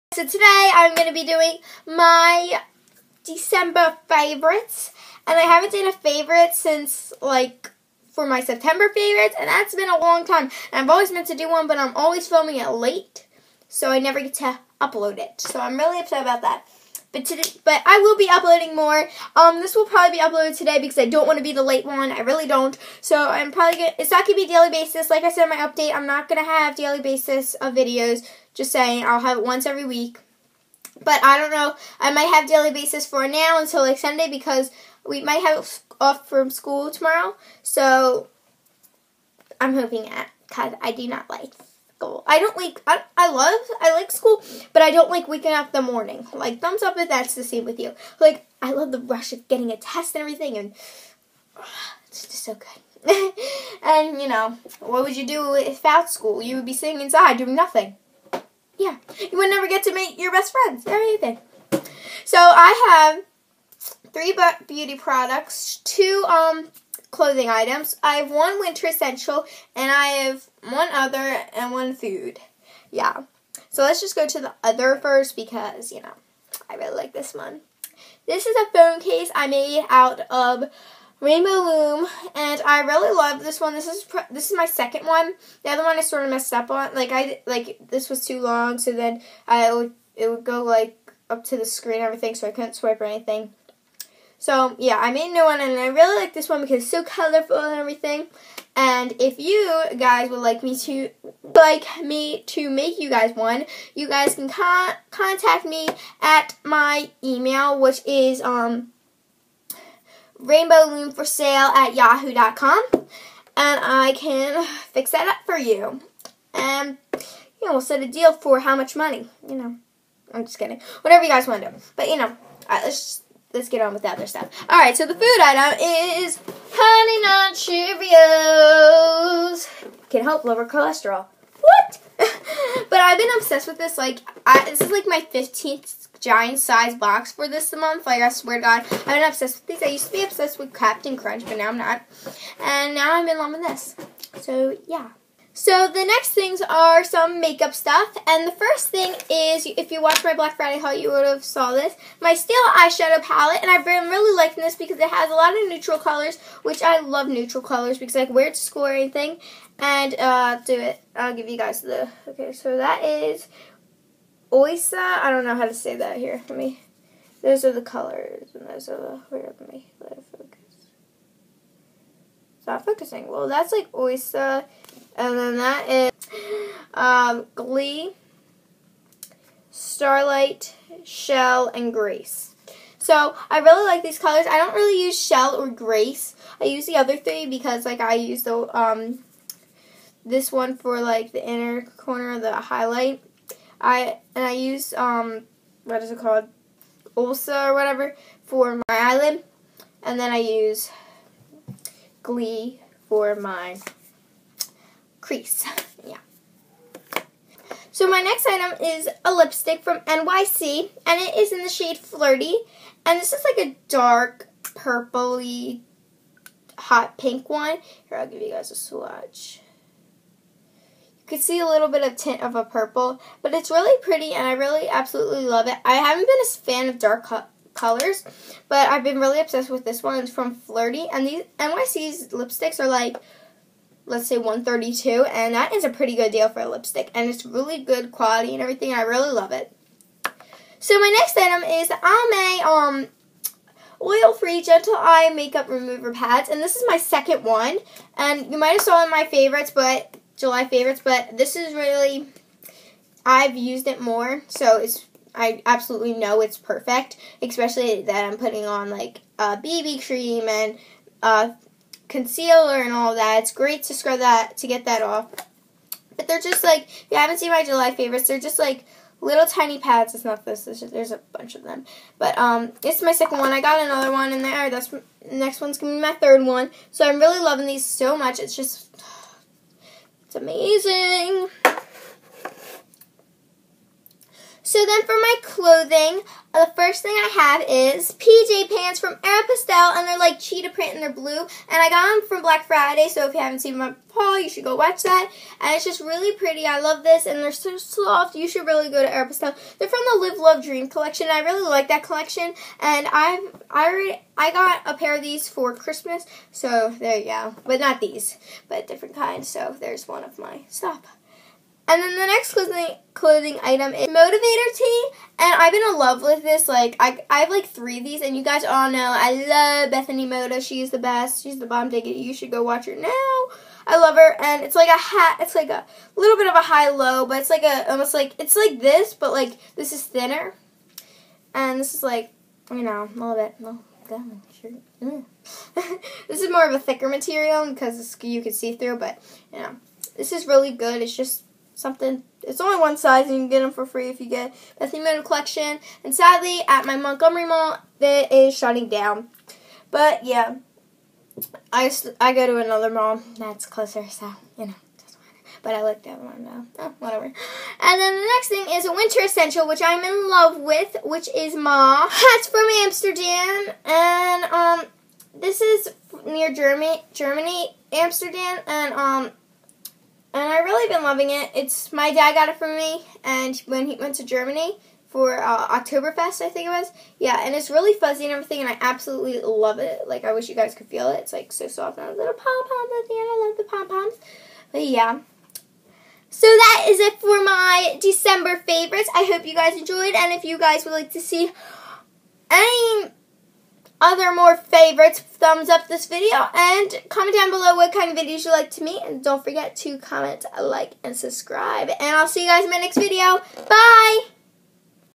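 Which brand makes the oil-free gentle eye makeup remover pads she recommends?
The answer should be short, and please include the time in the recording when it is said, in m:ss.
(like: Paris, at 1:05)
Almay, at 4:01.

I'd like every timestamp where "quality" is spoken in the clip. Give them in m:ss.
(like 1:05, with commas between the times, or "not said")
3:58.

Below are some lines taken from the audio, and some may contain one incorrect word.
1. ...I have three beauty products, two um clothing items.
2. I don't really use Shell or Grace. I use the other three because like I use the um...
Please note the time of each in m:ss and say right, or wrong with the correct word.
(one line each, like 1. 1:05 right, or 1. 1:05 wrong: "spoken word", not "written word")
1. 1:02 right
2. 3:04 right.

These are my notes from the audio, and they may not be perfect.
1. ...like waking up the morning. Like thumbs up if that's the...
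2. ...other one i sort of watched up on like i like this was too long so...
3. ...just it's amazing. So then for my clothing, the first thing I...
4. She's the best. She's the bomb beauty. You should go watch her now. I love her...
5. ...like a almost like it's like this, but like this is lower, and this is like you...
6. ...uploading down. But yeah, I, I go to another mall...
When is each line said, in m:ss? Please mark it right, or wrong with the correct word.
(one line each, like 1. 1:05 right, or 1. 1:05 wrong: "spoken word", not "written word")
1. 0:45 right
2. 1:25 wrong: "messed", not "watched"
3. 4:38 right
4. 5:20 wrong: "diggity", not "beauty"
5. 5:27 wrong: "thinner", not "lower"
6. 5:48 wrong: "shutting", not "uploading".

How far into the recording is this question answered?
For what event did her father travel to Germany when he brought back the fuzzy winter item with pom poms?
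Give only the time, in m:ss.
6:15.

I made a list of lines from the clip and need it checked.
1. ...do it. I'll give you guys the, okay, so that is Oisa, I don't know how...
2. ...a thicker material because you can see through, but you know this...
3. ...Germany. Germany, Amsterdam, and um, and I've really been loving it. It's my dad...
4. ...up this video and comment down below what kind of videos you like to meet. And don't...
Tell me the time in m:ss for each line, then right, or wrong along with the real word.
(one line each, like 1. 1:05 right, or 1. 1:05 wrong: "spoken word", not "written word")
1. 2:40 right
2. 5:36 right
3. 6:06 right
4. 6:35 right.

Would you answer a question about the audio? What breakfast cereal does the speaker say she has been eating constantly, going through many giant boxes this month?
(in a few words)
Honey Nut Cheerios.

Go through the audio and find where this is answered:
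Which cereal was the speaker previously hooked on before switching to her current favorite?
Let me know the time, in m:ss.
2:20.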